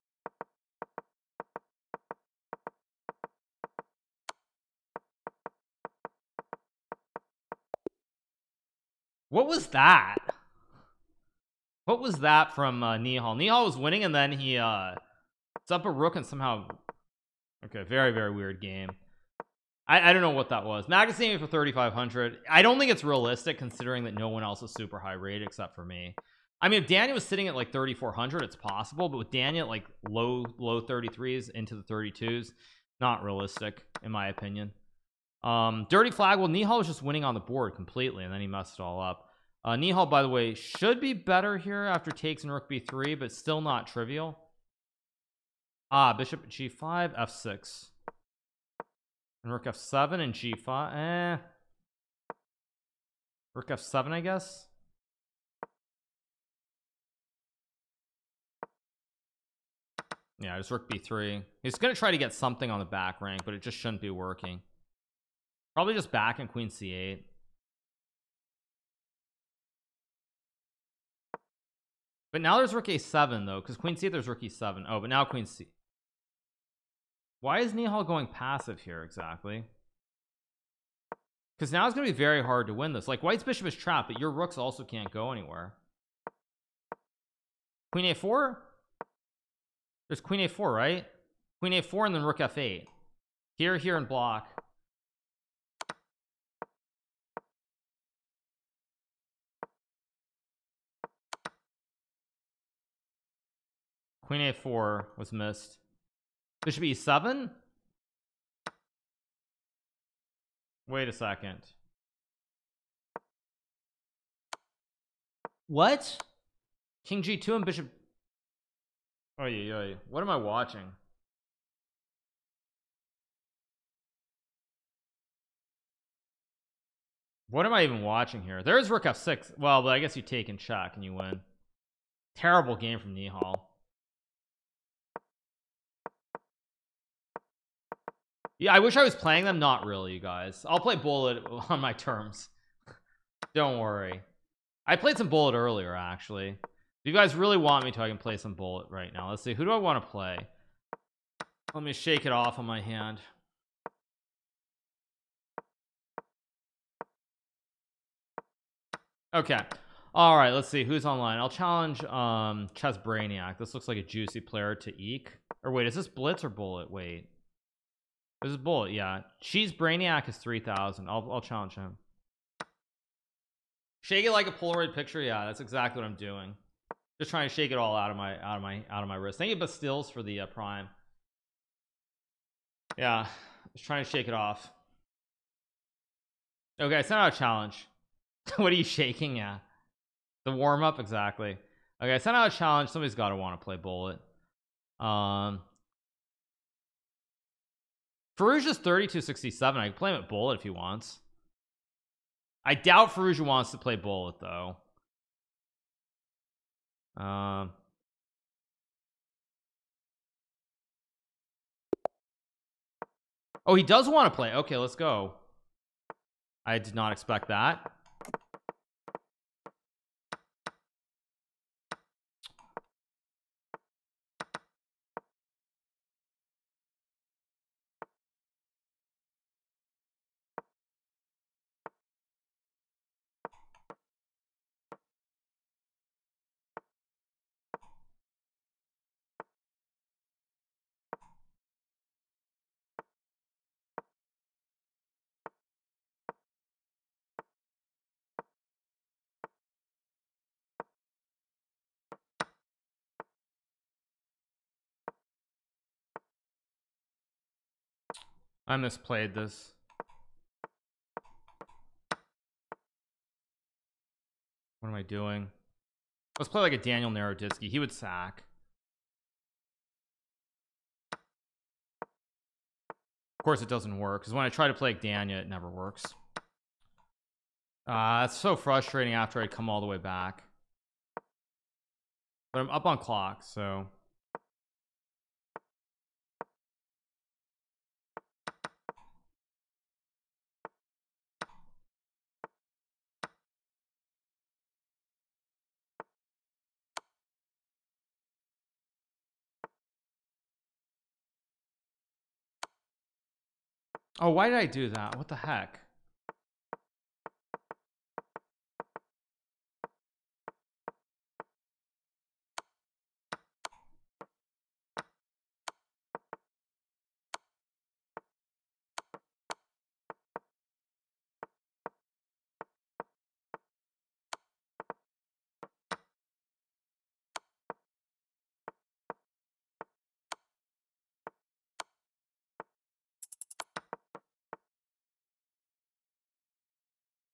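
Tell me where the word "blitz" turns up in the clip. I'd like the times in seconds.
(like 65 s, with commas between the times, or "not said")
166 s.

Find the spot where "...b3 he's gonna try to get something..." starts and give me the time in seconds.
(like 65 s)
60 s.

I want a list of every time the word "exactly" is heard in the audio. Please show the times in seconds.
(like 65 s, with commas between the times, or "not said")
79 s, 175 s, 190 s.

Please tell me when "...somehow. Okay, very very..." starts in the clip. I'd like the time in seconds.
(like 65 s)
16 s.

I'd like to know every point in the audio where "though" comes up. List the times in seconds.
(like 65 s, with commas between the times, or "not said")
73 s, 204 s.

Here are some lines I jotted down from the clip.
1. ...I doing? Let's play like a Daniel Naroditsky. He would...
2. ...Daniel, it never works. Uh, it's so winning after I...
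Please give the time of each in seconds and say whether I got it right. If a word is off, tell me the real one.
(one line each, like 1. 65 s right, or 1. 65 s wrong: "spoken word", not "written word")
1. 264 s right
2. 275 s wrong: "frustrating", not "winning".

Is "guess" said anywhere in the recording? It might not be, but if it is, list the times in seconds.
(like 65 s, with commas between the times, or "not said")
54 s, 129 s.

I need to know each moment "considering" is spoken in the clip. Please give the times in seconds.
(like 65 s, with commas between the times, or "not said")
23 s.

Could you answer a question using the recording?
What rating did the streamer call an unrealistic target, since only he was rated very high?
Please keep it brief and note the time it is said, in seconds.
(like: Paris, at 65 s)
3500, at 21 s.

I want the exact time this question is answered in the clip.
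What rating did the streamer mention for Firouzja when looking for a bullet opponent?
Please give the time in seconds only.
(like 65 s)
198 s.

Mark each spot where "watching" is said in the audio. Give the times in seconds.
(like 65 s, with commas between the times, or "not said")
120 s, 128 s.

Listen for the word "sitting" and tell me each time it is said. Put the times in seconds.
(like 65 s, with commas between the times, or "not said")
27 s.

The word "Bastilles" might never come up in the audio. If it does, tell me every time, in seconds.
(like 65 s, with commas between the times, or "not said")
179 s.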